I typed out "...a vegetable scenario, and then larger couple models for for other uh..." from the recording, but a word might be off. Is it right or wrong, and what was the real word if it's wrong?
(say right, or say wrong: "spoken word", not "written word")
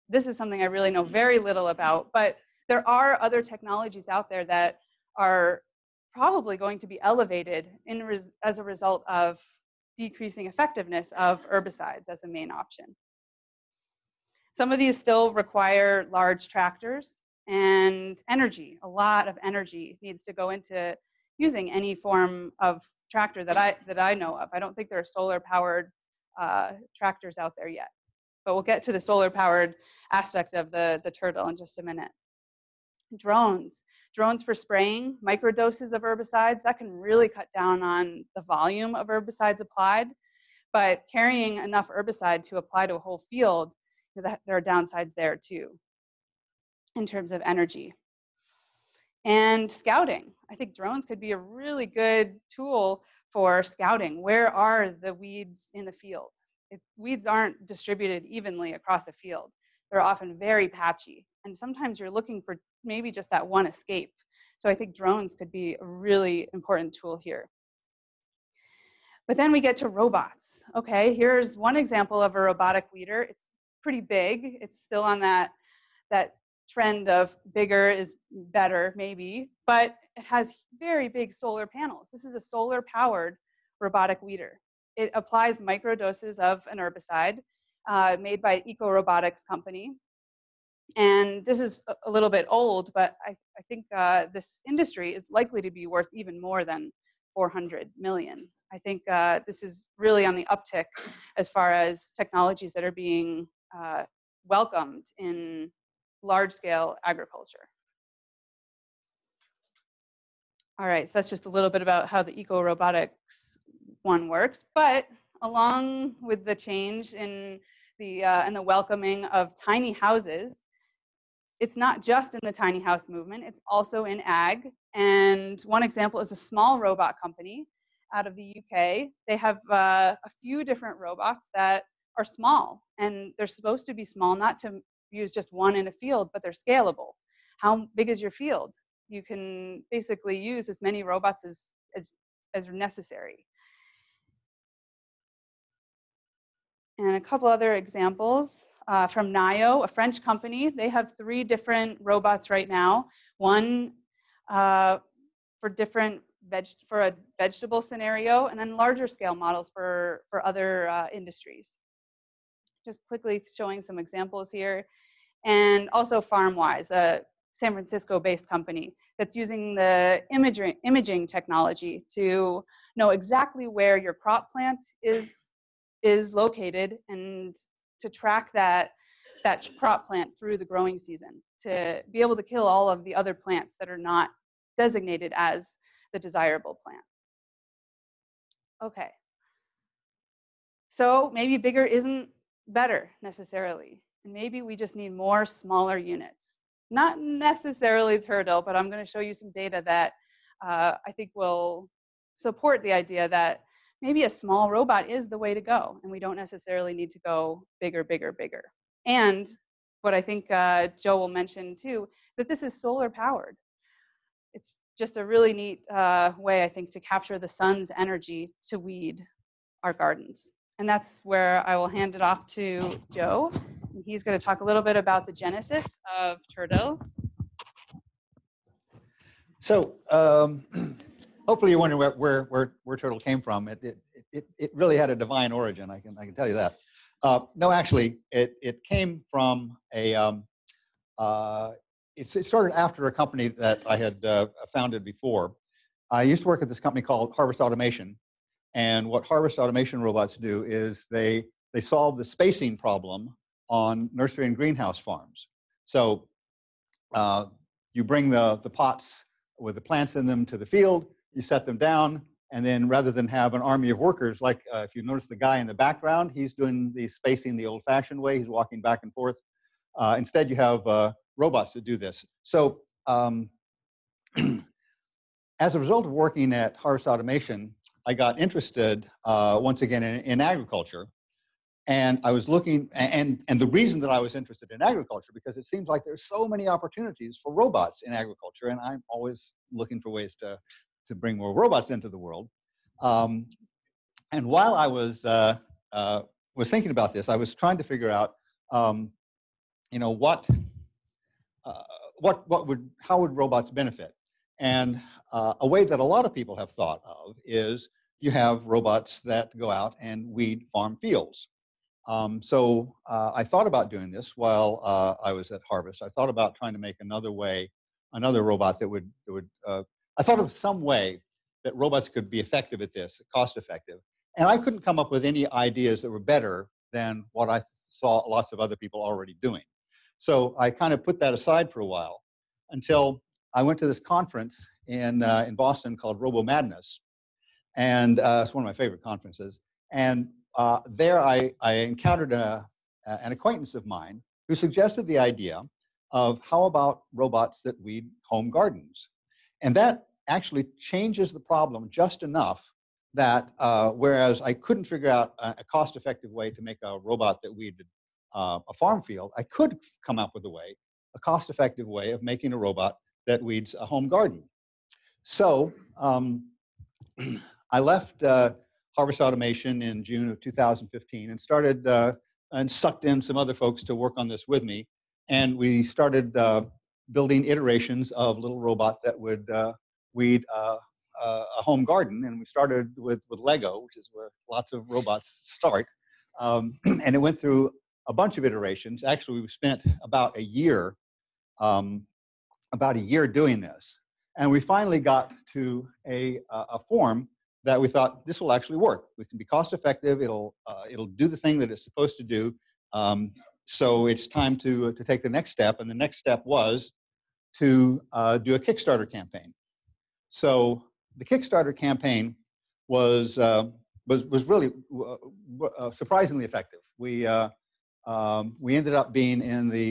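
wrong: "scale", not "couple".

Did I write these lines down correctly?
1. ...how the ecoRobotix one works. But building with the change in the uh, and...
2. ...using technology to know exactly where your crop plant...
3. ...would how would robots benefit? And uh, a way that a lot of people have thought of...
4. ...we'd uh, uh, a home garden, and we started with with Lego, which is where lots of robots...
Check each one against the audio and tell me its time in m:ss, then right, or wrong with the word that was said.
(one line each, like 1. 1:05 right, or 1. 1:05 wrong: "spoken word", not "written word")
1. 1:52 wrong: "along", not "building"
2. 2:50 wrong: "imaging", not "using"
3. 5:02 right
4. 6:20 right.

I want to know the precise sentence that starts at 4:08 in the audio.
And what Harvest Automation robots do is they, they solve the spacing problem on nursery and greenhouse farms.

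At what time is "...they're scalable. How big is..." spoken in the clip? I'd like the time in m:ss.
2:16.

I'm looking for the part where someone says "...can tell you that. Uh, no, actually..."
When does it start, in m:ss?
3:56.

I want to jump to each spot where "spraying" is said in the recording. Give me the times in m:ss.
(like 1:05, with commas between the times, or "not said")
0:34.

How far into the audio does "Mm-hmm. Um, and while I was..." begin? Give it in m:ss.
4:53.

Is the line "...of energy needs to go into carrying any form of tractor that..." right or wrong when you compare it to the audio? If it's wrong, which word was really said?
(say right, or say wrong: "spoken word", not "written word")
wrong: "using", not "carrying".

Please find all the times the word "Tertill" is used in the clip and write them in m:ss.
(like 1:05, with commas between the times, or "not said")
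0:31, 3:18, 3:52.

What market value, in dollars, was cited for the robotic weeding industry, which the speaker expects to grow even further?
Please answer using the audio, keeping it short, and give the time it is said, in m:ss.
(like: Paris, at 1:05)
400 million, at 1:37.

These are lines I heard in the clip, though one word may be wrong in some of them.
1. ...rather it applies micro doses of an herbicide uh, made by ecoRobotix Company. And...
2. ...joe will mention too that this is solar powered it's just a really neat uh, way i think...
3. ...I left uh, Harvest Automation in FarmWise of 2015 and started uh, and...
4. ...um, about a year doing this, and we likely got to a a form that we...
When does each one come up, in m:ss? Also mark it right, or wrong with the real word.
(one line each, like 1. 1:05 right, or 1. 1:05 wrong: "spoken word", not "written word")
1. 1:24 wrong: "weeder", not "rather"
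2. 3:31 right
3. 6:07 wrong: "June", not "FarmWise"
4. 6:31 wrong: "finally", not "likely".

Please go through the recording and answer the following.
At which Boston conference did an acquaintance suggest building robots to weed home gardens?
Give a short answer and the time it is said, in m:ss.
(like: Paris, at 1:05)
Robo Madness, at 5:36.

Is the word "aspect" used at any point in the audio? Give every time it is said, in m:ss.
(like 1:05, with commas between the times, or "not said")
0:30.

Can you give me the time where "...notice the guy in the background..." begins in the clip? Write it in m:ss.
4:25.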